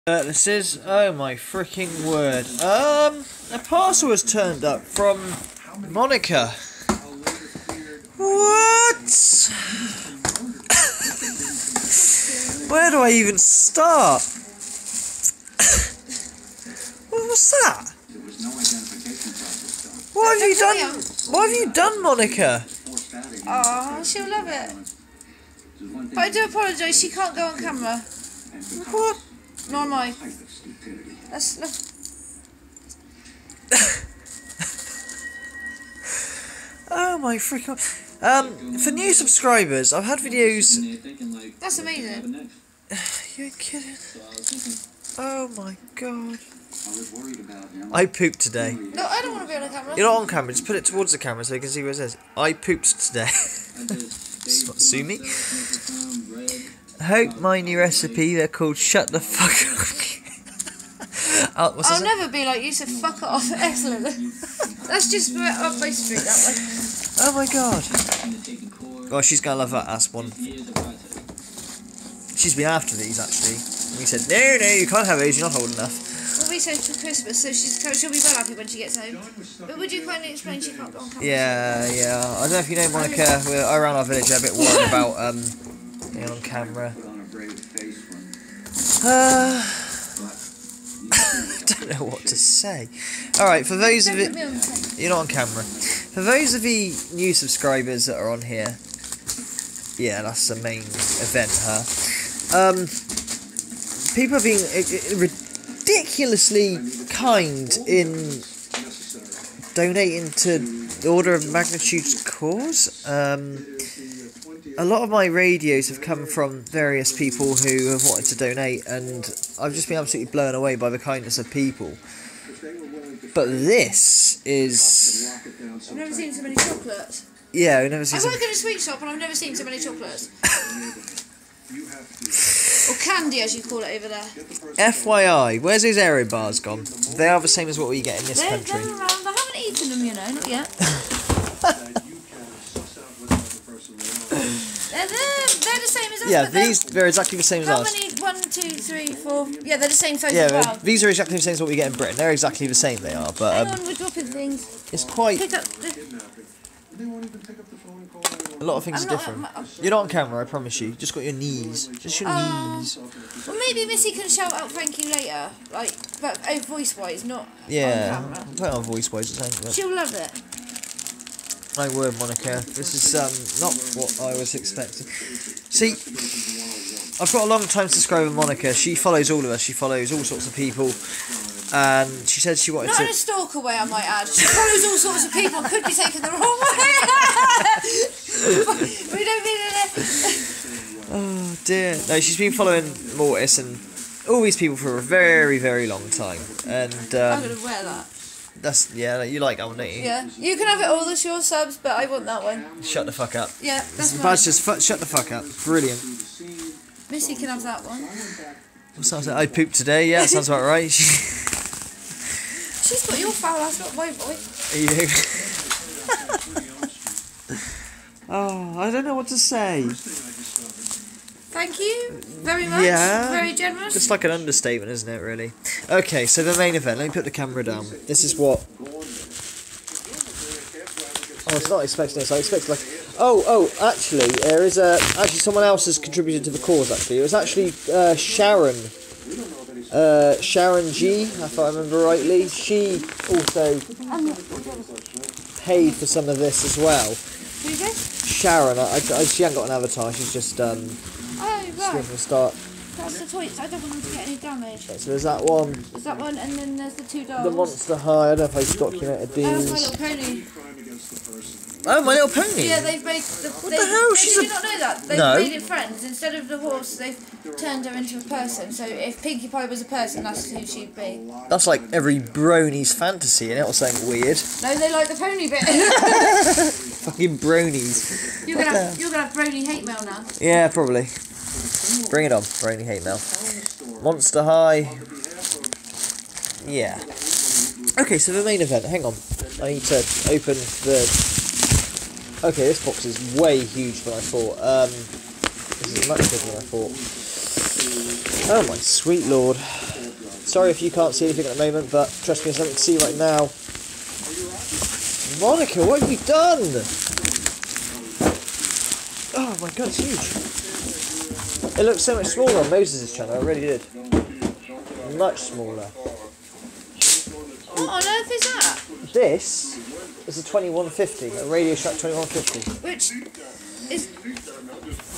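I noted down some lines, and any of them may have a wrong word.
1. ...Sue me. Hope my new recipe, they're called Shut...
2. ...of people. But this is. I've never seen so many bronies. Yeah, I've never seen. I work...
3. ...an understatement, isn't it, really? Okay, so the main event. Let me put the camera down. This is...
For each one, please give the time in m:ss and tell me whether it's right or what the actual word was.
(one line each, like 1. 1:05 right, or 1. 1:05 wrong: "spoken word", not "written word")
1. 0:54 right
2. 2:01 wrong: "chocolates", not "bronies"
3. 3:44 right.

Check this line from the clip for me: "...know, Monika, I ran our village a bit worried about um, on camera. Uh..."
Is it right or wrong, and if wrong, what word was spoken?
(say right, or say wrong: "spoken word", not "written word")
right.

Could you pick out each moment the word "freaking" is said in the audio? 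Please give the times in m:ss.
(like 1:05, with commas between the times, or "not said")
0:01, 0:37.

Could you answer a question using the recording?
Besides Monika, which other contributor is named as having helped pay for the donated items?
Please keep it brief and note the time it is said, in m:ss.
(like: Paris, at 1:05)
Sharon G, at 4:00.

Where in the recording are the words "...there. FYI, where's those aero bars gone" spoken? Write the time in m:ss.
2:14.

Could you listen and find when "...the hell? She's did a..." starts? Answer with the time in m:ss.
4:23.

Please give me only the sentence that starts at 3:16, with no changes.
And um, I'm gonna wear that.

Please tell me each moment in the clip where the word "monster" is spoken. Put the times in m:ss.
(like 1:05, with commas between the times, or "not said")
4:17, 4:44.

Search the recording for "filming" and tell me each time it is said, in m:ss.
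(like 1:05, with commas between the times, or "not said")
not said.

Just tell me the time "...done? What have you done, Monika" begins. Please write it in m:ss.
0:20.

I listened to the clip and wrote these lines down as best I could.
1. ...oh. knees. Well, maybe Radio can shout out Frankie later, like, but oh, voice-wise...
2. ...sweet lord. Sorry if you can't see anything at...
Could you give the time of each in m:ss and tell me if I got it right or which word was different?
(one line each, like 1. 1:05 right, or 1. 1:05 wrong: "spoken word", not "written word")
1. 2:42 wrong: "Missy", not "Radio"
2. 4:58 right.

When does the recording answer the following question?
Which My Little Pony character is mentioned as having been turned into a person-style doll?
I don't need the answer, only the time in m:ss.
4:29.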